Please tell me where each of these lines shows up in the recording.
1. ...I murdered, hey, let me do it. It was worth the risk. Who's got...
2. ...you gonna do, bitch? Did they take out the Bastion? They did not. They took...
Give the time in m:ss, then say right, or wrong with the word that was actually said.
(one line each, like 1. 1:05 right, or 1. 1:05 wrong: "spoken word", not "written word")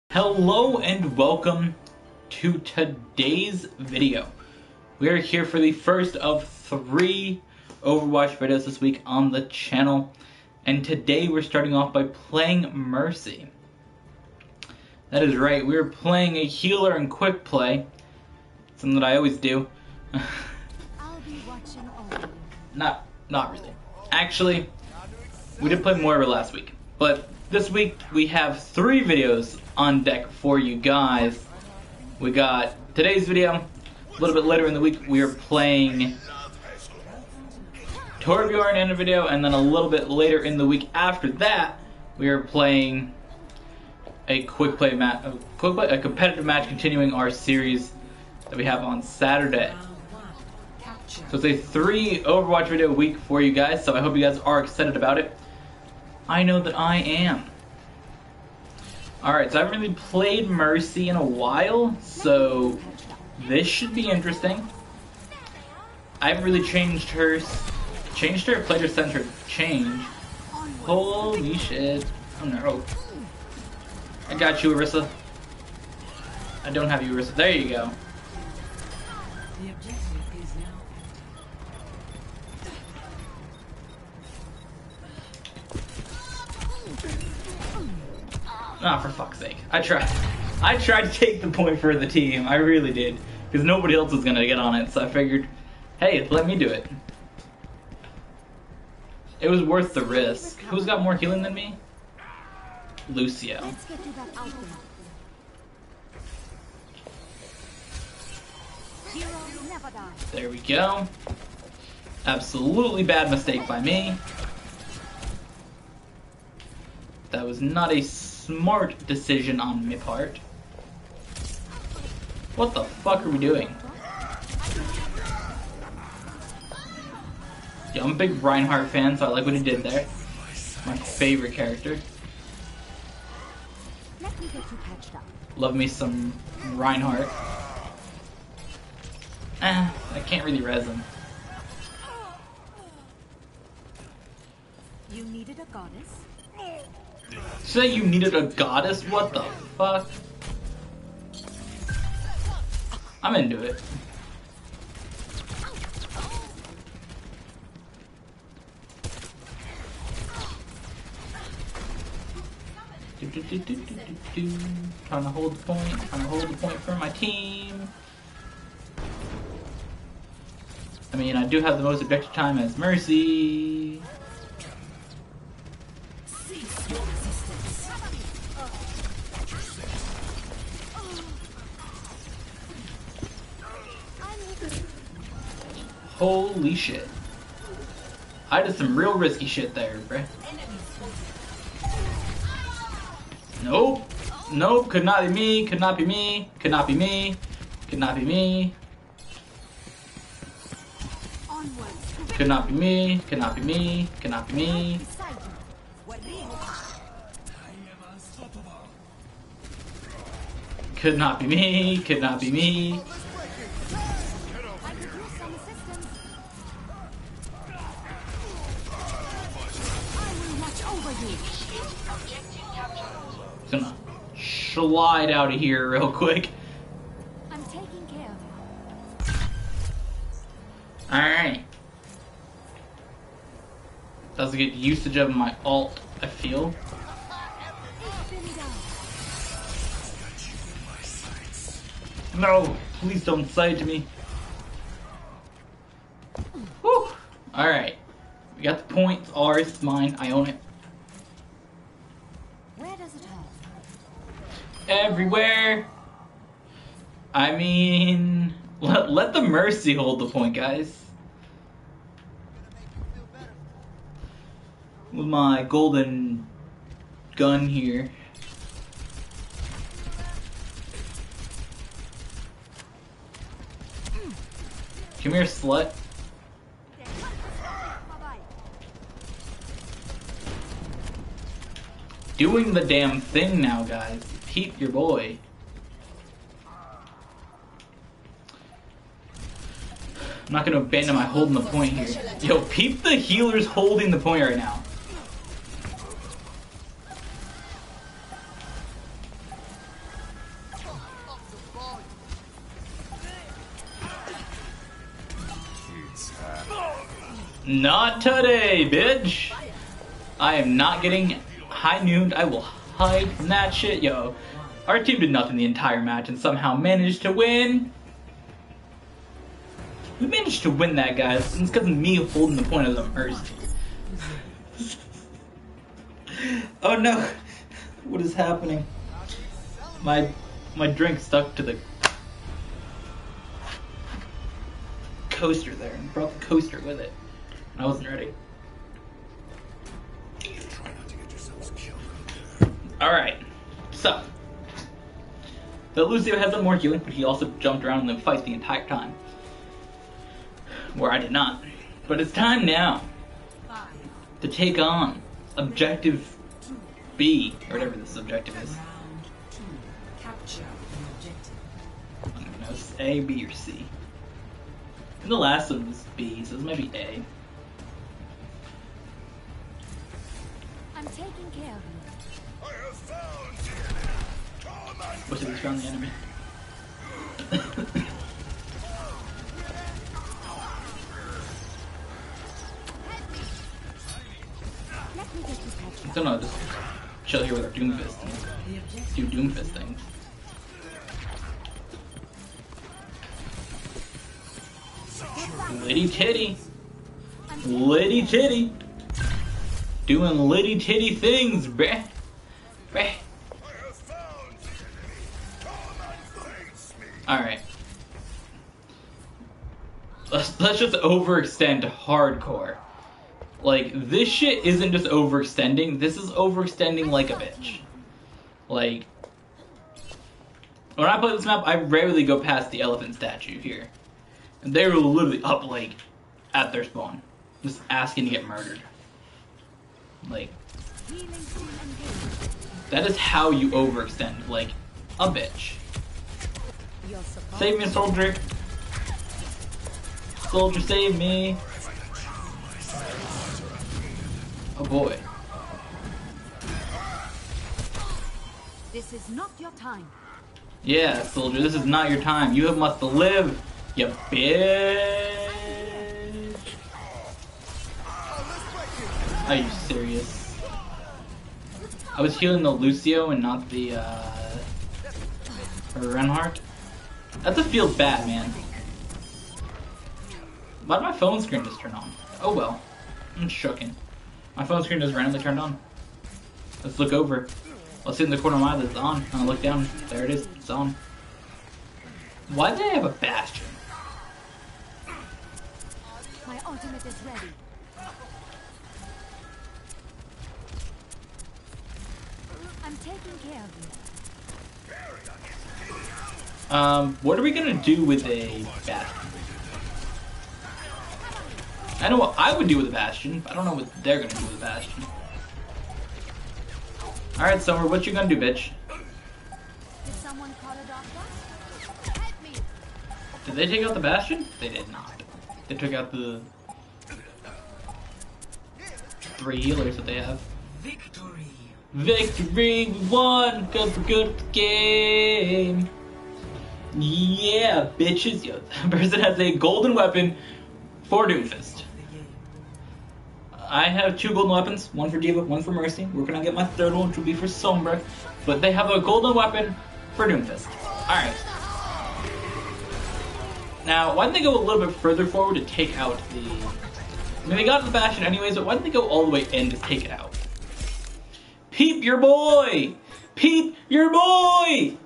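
1. 1:35 wrong: "figured", not "murdered"
2. 8:28 right.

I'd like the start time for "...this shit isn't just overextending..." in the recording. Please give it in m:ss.
6:54.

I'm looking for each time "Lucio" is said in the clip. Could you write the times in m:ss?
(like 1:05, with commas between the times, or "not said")
1:43, 5:46, 7:42.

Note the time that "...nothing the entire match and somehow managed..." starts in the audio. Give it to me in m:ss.
5:15.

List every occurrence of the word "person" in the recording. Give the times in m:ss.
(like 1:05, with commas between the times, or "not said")
8:48.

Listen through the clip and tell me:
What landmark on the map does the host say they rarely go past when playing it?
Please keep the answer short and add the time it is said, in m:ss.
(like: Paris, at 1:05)
the elephant statue, at 7:02.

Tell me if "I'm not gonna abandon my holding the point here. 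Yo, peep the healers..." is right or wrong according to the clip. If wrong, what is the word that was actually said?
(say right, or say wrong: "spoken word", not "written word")
right.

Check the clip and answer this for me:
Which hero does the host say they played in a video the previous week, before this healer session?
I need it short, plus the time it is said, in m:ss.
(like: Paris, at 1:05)
Moira, at 0:25.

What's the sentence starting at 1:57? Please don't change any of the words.
That was not a smart decision on my part.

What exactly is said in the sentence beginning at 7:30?
Yeah, soldier, this is not your time.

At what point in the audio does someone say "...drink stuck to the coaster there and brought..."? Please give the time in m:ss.
5:30.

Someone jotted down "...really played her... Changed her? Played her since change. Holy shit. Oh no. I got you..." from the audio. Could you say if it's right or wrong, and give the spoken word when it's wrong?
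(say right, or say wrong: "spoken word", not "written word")
wrong: "changed", not "played".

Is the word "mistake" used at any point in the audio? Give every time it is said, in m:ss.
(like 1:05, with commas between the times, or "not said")
1:53.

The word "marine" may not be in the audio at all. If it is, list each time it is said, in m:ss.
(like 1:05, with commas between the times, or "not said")
not said.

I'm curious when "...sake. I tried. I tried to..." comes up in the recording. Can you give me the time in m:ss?
1:29.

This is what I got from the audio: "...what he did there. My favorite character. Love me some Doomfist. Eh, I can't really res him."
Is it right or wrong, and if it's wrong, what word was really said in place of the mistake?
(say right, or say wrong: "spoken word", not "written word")
wrong: "Reinhardt", not "Doomfist".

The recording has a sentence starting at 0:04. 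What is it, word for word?
We are here for the first of three Overwatch videos this week on the channel.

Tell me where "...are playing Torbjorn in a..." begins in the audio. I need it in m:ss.
0:35.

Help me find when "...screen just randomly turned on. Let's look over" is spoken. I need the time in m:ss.
7:54.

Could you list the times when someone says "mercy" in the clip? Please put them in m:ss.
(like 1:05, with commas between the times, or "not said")
0:12, 1:00, 2:52, 4:19, 5:23, 8:55.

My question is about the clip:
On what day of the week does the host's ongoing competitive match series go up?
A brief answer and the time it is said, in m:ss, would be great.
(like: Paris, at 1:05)
Saturday, at 0:49.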